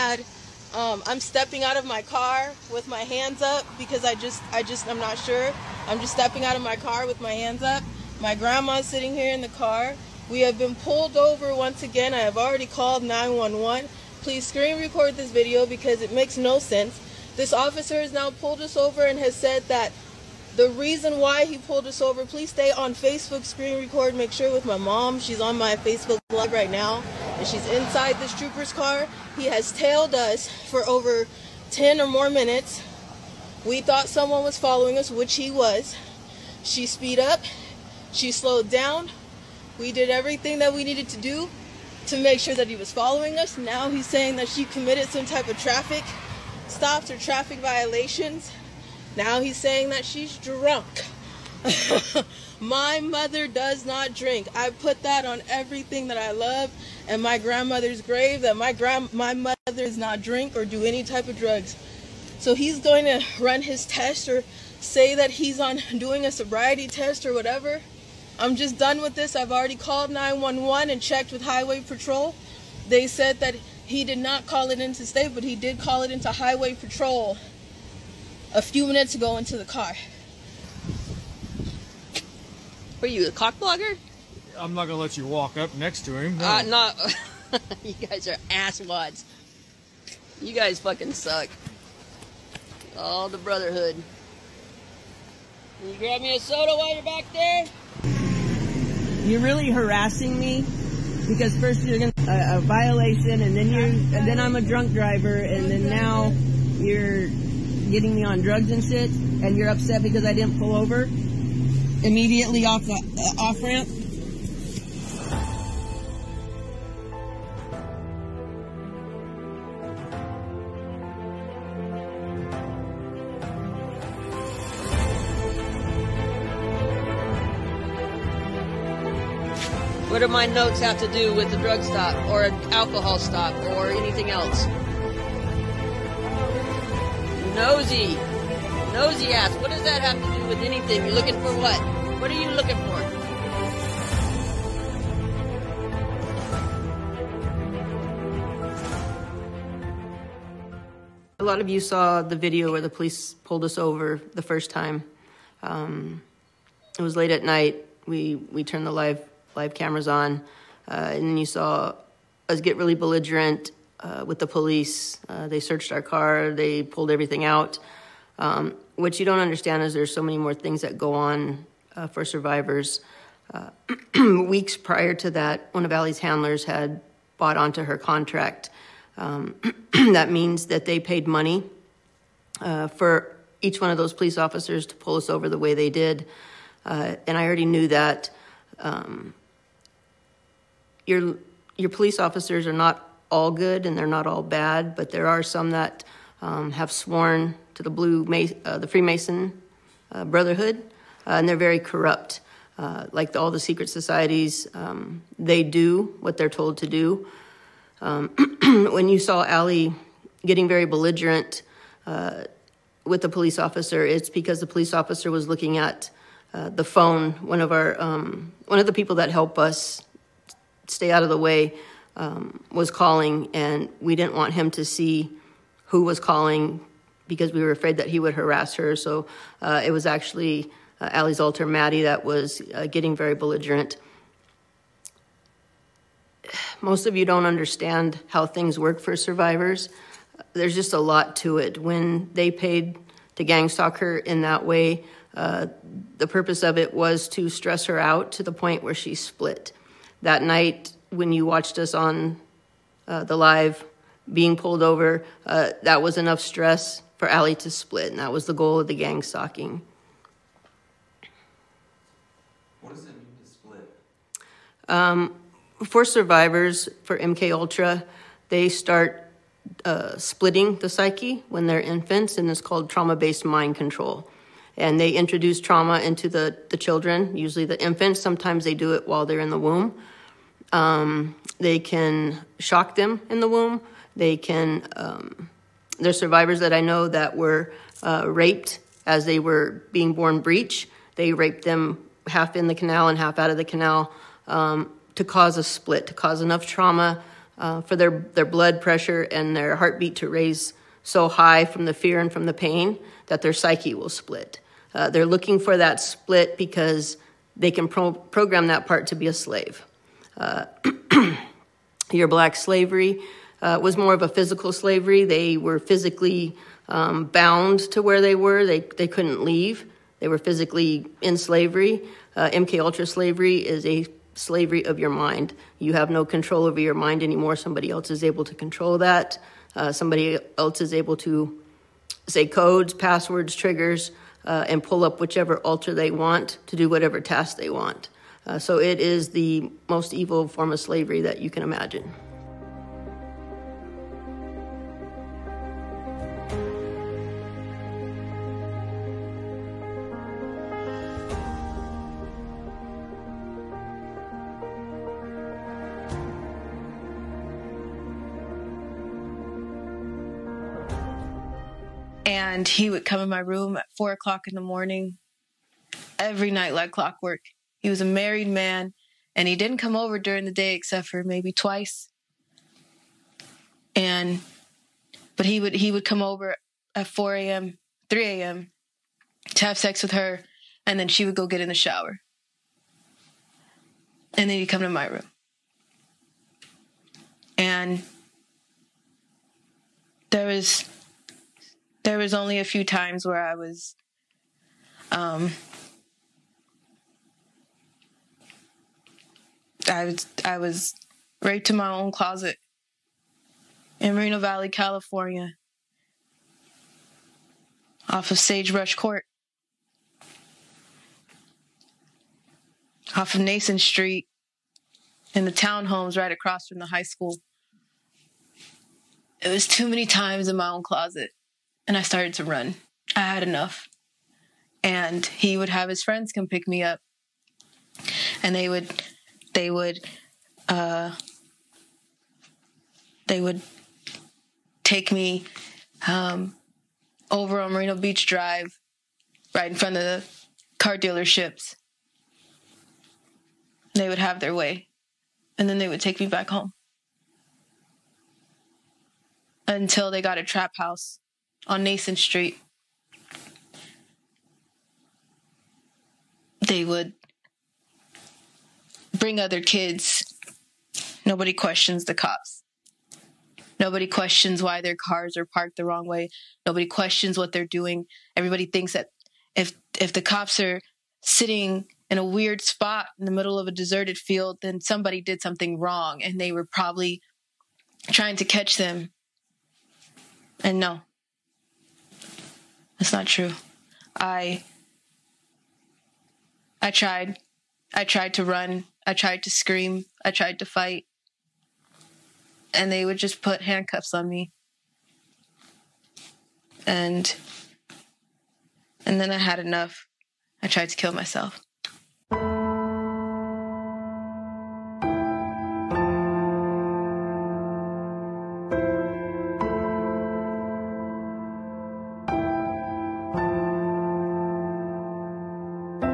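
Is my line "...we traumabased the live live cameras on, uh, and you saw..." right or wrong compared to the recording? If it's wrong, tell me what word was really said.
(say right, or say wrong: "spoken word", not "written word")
wrong: "turned", not "traumabased".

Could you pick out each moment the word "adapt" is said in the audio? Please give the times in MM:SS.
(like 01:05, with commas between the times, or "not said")
not said.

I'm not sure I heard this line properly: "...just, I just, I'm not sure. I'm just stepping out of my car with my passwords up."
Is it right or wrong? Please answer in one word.
wrong.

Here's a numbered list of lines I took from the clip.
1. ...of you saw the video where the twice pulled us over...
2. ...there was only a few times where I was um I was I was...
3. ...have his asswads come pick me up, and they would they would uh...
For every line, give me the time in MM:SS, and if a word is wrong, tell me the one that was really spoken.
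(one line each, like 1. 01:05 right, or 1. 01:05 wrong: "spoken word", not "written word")
1. 02:31 wrong: "police", not "twice"
2. 06:32 right
3. 07:05 wrong: "friends", not "asswads".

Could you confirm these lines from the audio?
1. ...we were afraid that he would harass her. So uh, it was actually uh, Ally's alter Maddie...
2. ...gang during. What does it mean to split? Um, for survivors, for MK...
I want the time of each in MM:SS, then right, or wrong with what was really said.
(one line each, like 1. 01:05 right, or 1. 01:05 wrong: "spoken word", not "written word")
1. 03:47 right
2. 04:18 wrong: "stalking", not "during".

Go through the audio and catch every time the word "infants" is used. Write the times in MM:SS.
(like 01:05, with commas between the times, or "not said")
04:31, 04:37.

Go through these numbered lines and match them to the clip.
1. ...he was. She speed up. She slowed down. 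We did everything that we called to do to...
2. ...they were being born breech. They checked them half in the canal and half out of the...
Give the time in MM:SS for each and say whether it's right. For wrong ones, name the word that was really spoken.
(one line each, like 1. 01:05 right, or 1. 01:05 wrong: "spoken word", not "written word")
1. 00:35 wrong: "needed", not "called"
2. 04:49 wrong: "raped", not "checked".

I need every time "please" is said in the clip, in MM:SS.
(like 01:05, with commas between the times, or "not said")
00:14, 00:22.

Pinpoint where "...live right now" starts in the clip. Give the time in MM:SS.
00:26.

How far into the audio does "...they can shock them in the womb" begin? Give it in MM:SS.
04:41.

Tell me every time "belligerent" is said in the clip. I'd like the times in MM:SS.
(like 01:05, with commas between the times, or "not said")
02:42, 03:30, 03:53.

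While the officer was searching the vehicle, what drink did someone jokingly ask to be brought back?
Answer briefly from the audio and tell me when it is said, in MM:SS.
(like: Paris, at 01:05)
Soda, at 01:36.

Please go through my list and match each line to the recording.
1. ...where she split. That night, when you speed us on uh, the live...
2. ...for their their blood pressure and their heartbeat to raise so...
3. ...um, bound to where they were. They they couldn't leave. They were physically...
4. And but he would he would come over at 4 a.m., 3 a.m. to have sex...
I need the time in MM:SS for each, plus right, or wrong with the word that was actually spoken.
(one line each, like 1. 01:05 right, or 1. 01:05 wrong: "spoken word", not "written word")
1. 04:08 wrong: "watched", not "speed"
2. 04:57 right
3. 05:16 right
4. 06:13 right.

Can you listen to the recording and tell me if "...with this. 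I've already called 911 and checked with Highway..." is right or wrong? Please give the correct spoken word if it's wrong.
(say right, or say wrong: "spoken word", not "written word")
right.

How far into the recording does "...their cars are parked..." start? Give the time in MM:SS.
07:44.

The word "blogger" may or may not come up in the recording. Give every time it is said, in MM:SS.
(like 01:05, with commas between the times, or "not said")
01:23.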